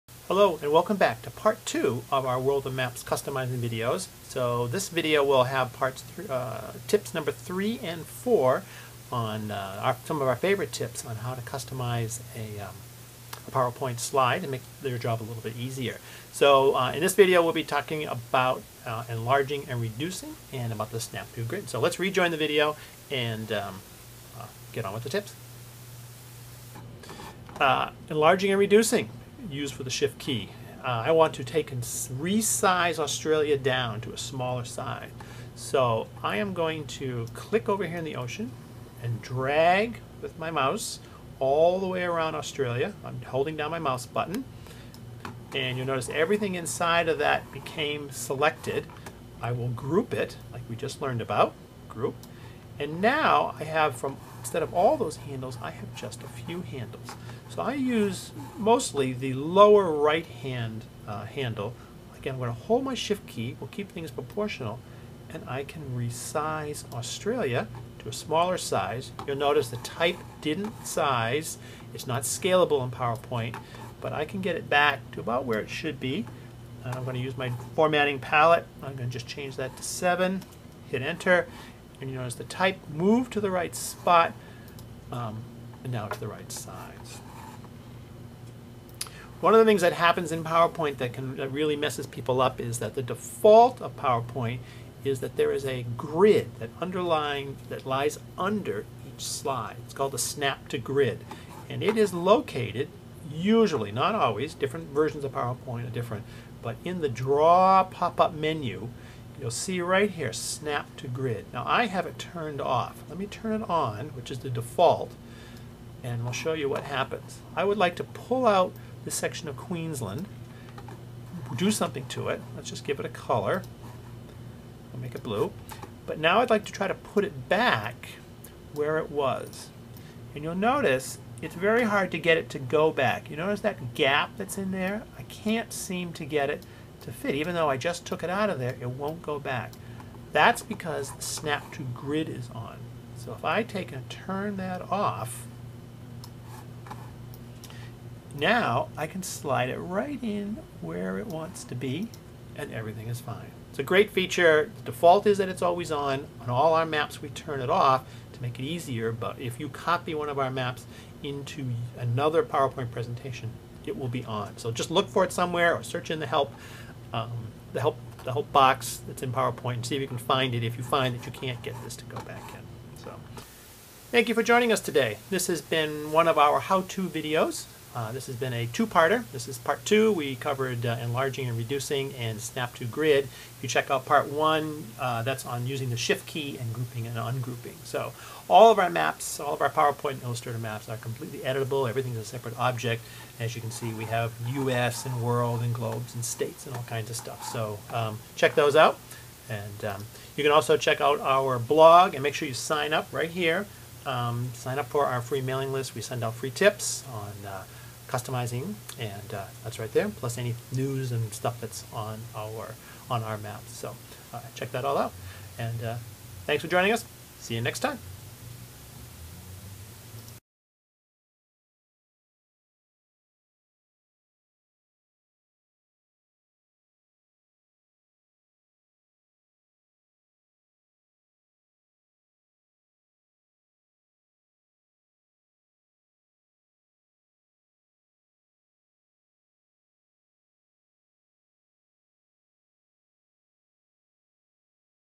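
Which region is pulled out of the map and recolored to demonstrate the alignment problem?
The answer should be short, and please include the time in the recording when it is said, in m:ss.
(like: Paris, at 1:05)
Queensland, at 1:59.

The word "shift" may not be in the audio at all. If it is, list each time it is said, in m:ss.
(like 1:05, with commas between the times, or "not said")
0:29, 1:02, 3:05.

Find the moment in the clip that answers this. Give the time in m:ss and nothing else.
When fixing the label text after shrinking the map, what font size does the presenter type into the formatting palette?
1:19.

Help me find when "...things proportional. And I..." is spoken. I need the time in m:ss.
1:03.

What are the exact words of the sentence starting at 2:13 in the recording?
You notice that gap that's in there?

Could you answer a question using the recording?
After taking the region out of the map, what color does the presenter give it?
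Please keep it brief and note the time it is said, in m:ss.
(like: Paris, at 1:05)
Blue, at 2:05.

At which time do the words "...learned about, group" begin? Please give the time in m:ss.
0:51.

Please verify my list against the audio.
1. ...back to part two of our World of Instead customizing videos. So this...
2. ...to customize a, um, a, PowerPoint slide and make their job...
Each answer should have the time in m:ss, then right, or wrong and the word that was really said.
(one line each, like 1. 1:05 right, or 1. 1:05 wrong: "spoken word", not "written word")
1. 0:00 wrong: "Maps", not "Instead"
2. 0:11 right.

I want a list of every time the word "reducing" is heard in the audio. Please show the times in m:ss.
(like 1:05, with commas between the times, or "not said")
0:19, 0:28, 3:01.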